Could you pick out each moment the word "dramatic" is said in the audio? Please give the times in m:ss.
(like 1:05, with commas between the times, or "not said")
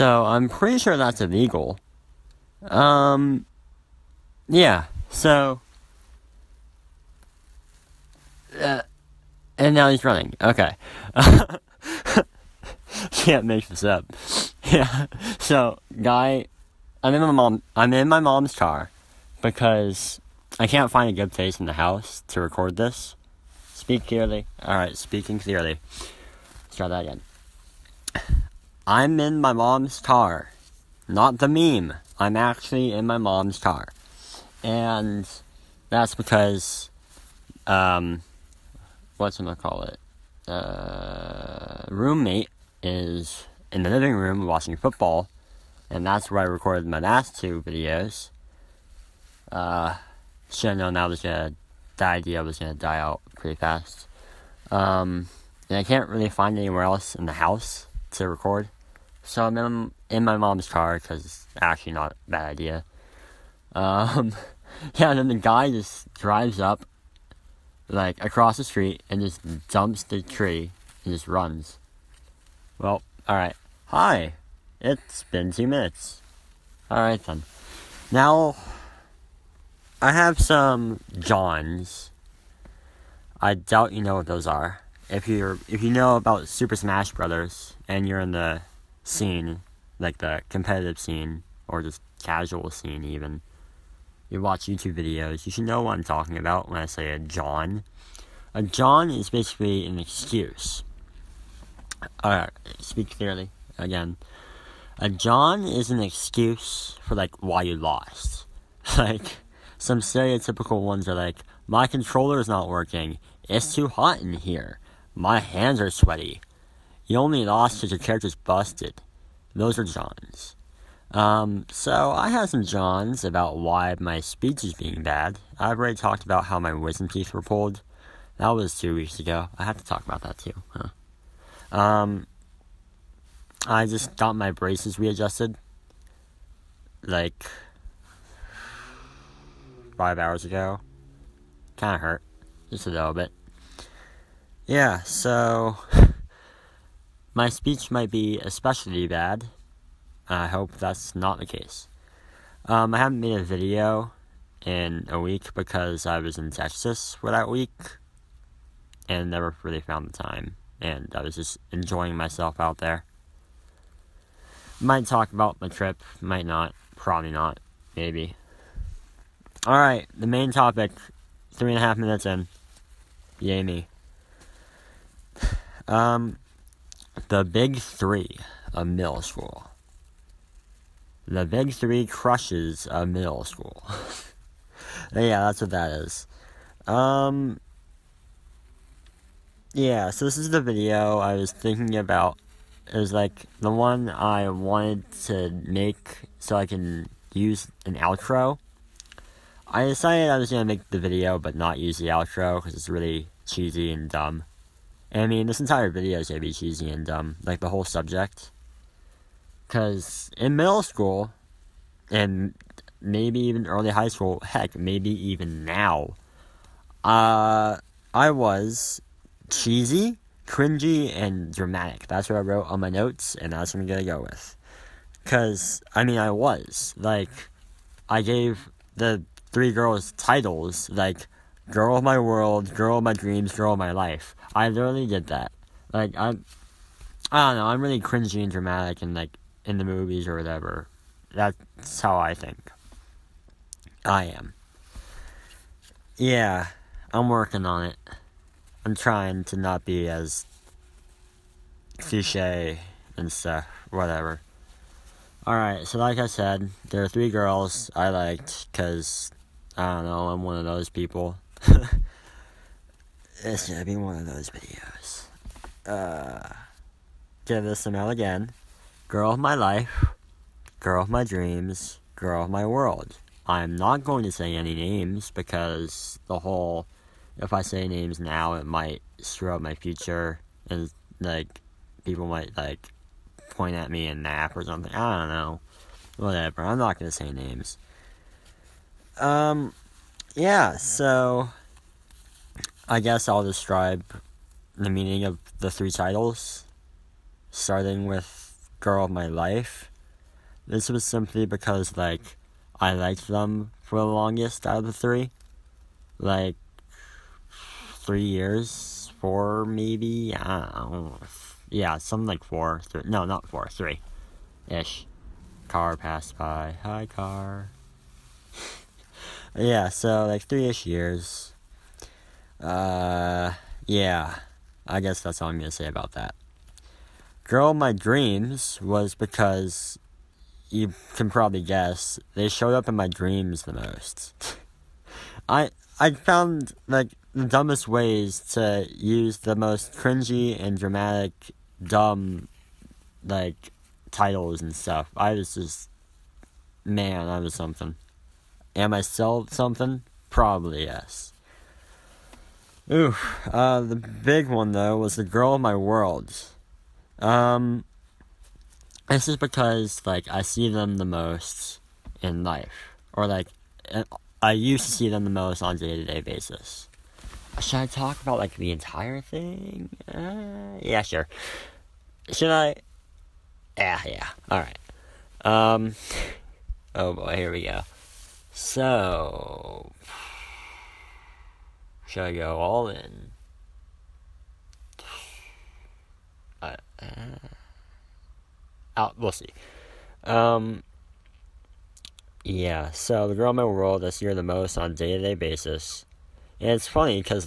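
3:41, 3:58, 5:40.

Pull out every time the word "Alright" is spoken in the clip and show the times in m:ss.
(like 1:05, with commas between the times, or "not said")
1:16, 1:42, 2:49, 4:15.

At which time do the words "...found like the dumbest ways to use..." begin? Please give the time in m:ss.
5:36.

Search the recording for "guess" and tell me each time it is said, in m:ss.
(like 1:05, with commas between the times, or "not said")
4:52, 5:24, 5:31.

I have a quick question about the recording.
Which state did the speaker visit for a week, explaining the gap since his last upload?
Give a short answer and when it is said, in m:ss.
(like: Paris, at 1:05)
Texas, at 2:36.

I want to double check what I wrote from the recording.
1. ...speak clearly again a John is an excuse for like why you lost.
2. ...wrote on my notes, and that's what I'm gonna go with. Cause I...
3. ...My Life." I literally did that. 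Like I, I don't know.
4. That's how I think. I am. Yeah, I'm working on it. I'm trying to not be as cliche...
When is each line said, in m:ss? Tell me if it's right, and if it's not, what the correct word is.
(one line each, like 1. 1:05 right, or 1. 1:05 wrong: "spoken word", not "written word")
1. 1:42 right
2. 3:42 right
3. 3:53 right
4. 4:01 right.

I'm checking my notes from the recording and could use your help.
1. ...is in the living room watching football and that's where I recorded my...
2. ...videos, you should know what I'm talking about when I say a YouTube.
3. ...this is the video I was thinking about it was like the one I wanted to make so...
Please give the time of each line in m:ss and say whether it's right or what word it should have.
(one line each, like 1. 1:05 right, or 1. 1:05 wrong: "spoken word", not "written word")
1. 0:42 right
2. 1:34 wrong: "John", not "YouTube"
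3. 3:10 right.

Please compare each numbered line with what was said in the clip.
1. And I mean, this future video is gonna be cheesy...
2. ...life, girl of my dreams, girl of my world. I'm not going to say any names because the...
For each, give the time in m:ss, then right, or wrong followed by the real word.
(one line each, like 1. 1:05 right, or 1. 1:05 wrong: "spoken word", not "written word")
1. 3:25 wrong: "entire", not "future"
2. 4:29 right.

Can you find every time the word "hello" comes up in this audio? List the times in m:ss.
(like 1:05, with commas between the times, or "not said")
not said.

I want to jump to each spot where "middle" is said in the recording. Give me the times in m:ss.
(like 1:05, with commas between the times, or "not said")
2:58, 3:03, 3:30.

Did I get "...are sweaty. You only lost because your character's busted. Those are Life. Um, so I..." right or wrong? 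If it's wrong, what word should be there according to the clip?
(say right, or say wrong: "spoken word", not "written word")
wrong: "Johns", not "Life".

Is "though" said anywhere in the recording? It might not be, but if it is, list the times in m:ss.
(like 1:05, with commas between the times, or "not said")
5:54.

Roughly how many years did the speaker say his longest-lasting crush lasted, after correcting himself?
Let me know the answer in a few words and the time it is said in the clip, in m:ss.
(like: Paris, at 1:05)
3, at 5:20.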